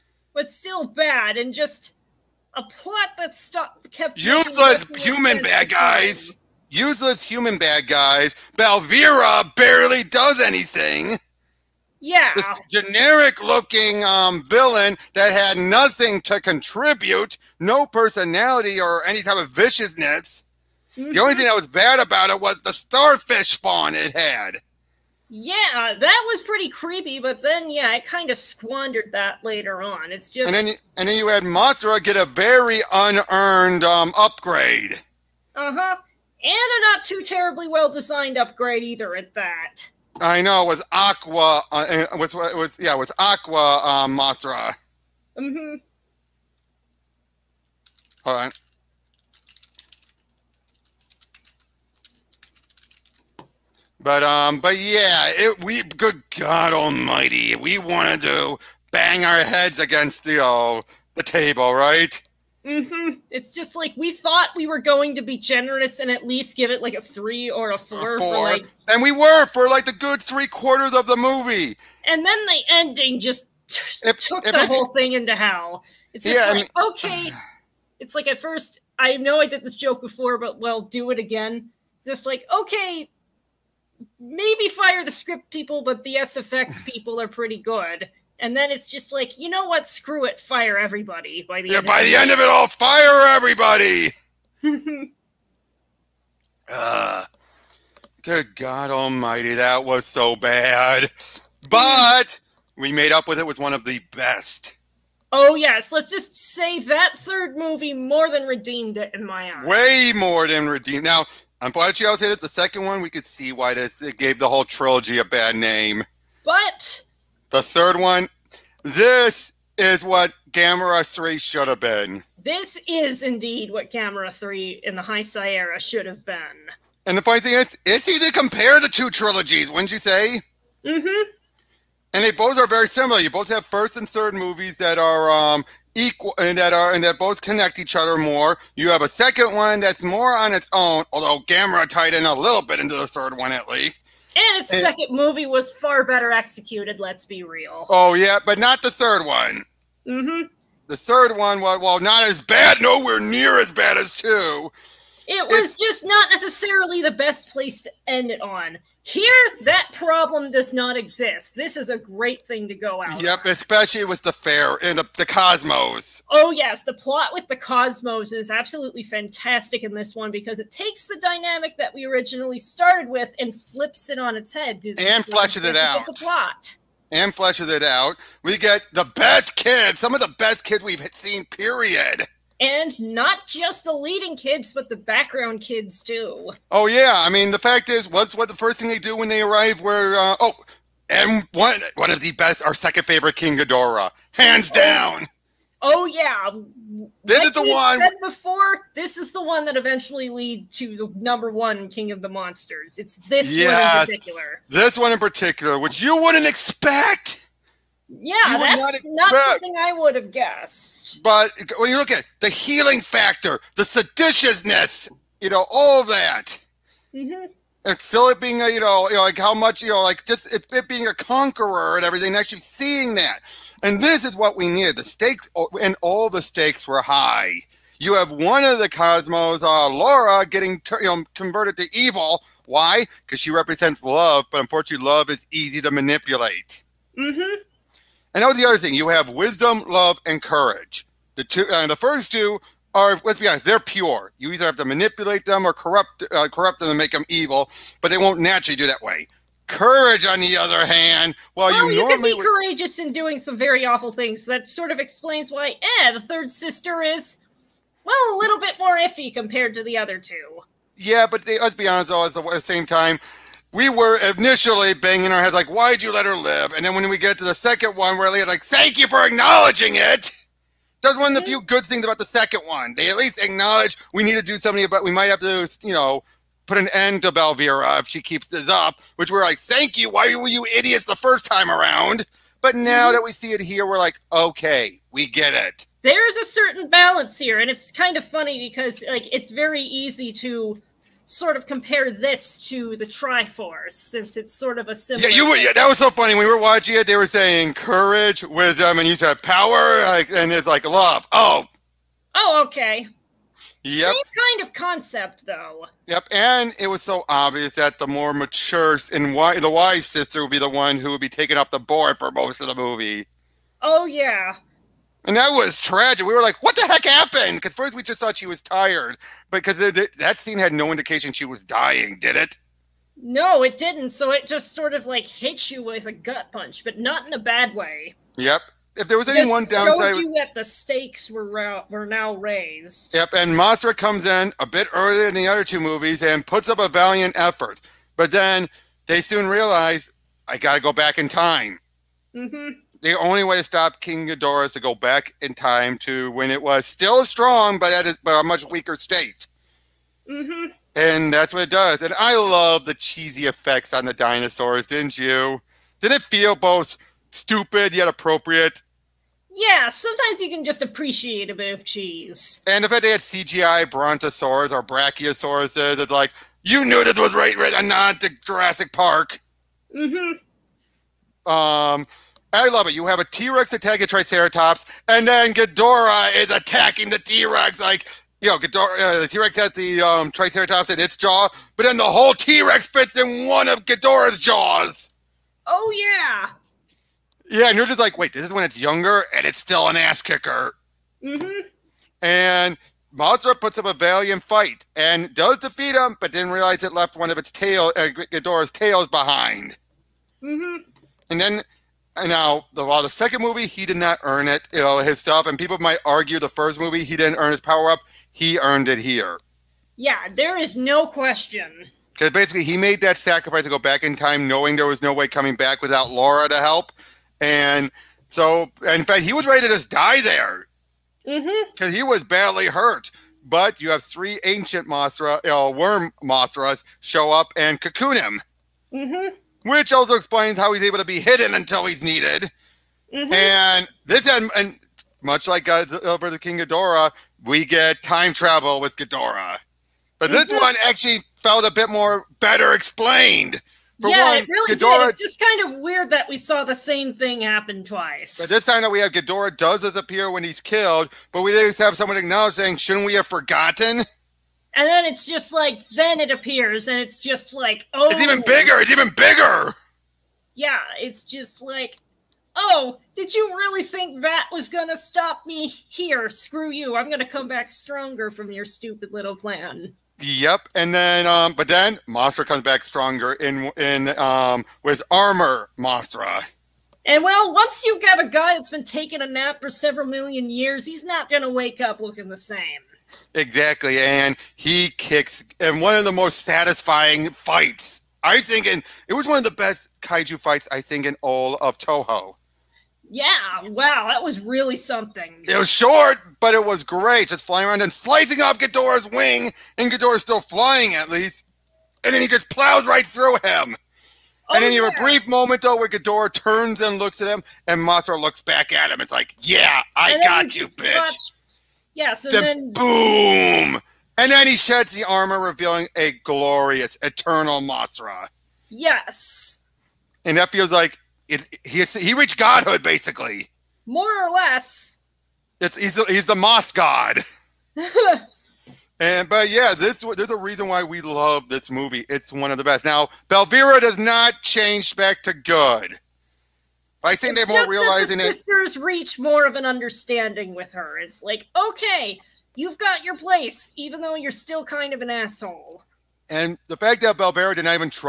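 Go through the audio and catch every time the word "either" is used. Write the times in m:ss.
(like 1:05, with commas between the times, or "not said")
0:38, 4:04.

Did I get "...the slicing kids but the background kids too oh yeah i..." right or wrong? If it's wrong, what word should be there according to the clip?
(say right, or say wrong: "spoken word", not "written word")
wrong: "leading", not "slicing".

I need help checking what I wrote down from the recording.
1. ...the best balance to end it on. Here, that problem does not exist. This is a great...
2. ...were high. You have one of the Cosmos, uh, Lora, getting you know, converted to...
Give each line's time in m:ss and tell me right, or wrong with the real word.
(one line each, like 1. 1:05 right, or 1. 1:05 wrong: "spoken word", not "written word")
1. 2:37 wrong: "place", not "balance"
2. 3:46 right.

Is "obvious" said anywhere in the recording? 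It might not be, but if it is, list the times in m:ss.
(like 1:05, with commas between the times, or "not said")
5:07.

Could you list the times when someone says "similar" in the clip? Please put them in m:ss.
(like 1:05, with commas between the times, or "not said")
2:12, 4:54.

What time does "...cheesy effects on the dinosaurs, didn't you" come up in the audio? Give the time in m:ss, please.
5:52.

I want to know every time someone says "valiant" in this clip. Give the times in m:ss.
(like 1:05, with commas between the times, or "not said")
5:36, 6:33.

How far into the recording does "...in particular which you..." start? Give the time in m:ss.
3:25.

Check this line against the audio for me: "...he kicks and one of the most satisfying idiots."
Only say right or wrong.
wrong.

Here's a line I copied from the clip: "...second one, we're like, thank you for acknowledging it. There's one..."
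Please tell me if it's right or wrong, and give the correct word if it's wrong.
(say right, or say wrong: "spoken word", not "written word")
right.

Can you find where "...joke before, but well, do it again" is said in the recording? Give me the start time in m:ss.
1:19.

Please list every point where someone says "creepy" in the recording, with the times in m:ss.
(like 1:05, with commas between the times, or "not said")
0:26.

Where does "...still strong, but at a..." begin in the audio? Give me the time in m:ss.
5:46.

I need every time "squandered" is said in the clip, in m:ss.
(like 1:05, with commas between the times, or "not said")
0:28.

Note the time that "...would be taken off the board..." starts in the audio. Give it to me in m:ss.
5:11.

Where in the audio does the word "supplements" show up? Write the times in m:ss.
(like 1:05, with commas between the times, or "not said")
not said.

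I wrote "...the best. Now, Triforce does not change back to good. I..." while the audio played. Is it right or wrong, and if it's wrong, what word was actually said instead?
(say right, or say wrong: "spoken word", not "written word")
wrong: "Belvera", not "Triforce".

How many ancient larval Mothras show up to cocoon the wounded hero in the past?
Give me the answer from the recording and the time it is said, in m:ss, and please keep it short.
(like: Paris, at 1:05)
3, at 7:04.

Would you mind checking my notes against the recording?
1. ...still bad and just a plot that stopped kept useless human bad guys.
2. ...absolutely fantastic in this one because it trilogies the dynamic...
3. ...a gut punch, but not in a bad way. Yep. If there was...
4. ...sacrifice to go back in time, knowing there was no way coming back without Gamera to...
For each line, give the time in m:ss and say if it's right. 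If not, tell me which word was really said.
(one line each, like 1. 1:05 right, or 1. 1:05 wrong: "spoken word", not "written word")
1. 0:00 right
2. 2:48 wrong: "takes", not "trilogies"
3. 5:26 right
4. 6:53 wrong: "Lora", not "Gamera".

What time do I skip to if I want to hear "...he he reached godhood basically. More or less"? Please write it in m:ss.
8:41.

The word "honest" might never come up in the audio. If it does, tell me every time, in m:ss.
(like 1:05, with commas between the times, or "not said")
4:03, 4:21.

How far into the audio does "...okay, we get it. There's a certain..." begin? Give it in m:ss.
4:44.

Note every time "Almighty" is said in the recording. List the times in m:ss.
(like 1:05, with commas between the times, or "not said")
0:56, 1:38.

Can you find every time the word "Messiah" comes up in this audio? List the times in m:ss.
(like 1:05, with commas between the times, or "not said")
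not said.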